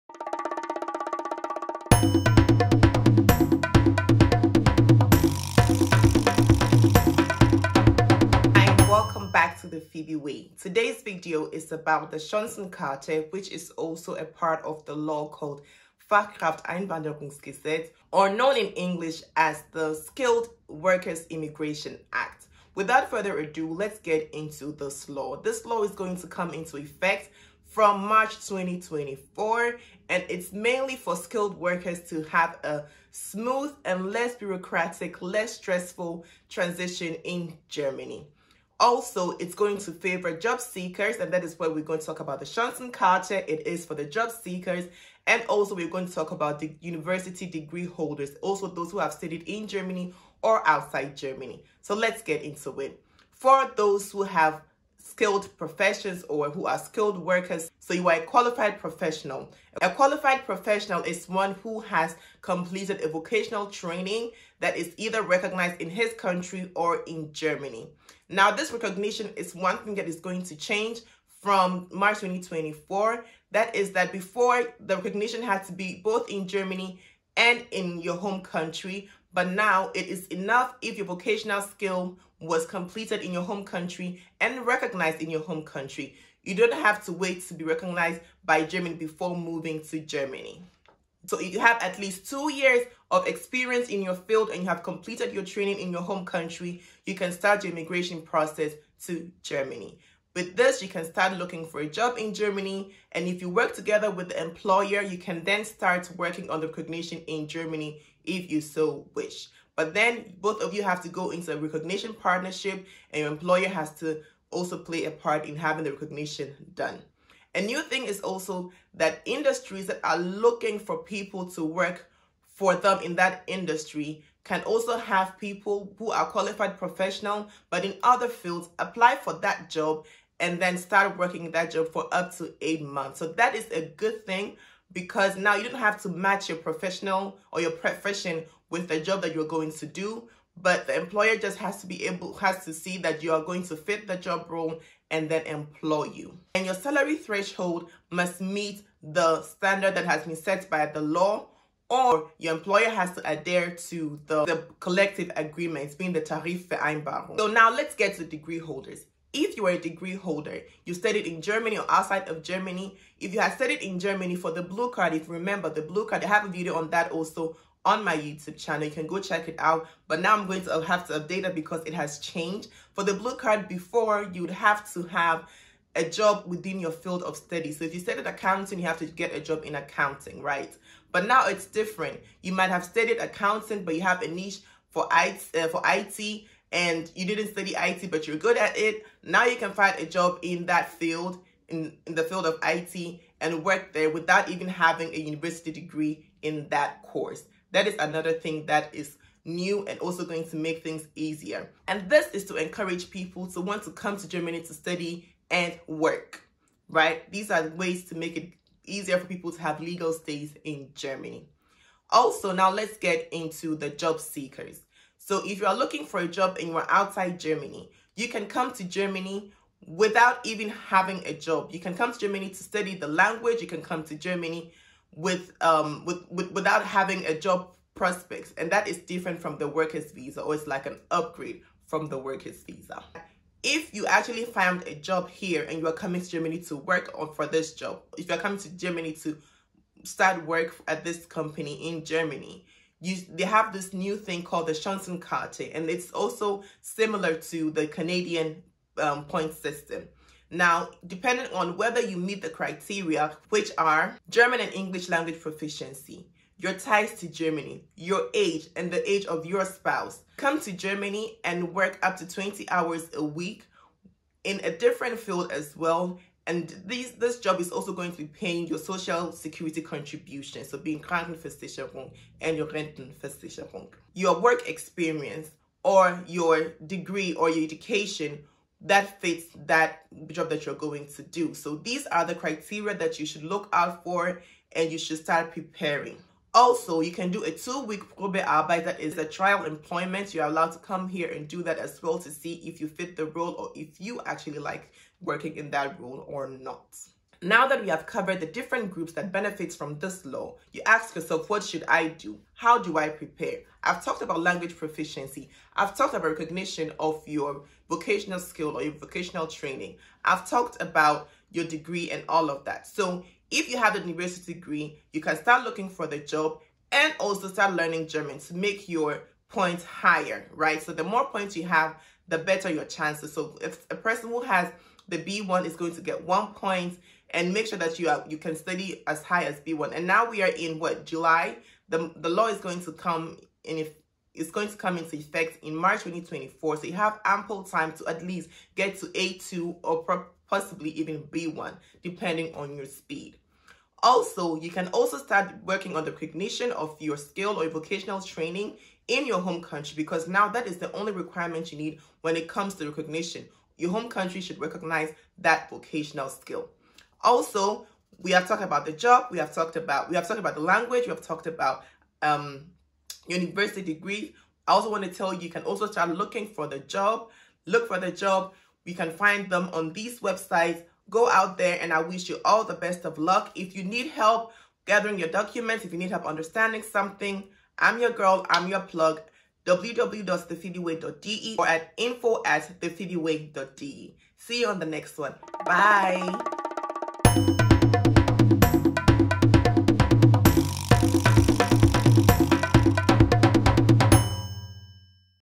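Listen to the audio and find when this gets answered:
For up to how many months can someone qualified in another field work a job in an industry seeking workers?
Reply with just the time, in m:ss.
2:12.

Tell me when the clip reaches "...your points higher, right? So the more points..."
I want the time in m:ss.
5:18.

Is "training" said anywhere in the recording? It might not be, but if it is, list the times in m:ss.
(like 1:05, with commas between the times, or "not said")
1:03, 1:35, 5:09, 5:48.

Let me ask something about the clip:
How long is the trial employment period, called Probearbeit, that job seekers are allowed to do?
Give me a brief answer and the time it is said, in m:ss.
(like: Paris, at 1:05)
2 weeks, at 4:47.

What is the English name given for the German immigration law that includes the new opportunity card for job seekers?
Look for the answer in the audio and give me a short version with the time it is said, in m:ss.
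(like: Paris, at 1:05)
Skilled Workers Immigration Act, at 0:19.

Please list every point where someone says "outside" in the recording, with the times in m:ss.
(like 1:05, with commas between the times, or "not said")
0:50, 2:41, 3:36.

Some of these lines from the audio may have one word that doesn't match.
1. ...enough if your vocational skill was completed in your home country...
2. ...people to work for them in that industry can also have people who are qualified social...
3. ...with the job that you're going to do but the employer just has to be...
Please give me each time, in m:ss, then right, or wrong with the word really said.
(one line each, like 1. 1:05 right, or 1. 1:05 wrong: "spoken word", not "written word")
1. 1:20 right
2. 2:00 wrong: "professional", not "social"
3. 2:18 right.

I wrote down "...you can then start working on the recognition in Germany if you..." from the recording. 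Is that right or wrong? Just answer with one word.
right.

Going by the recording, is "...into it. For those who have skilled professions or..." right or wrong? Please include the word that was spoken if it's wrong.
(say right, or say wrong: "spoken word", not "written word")
right.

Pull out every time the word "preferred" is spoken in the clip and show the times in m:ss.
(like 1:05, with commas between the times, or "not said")
not said.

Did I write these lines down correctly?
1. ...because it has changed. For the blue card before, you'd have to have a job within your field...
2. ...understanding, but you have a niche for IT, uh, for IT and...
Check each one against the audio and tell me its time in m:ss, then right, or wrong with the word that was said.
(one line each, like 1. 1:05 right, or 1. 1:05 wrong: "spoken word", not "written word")
1. 2:51 right
2. 3:03 wrong: "accounting", not "understanding".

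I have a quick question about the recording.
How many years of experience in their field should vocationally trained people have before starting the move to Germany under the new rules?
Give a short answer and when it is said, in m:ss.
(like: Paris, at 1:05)
2, at 1:32.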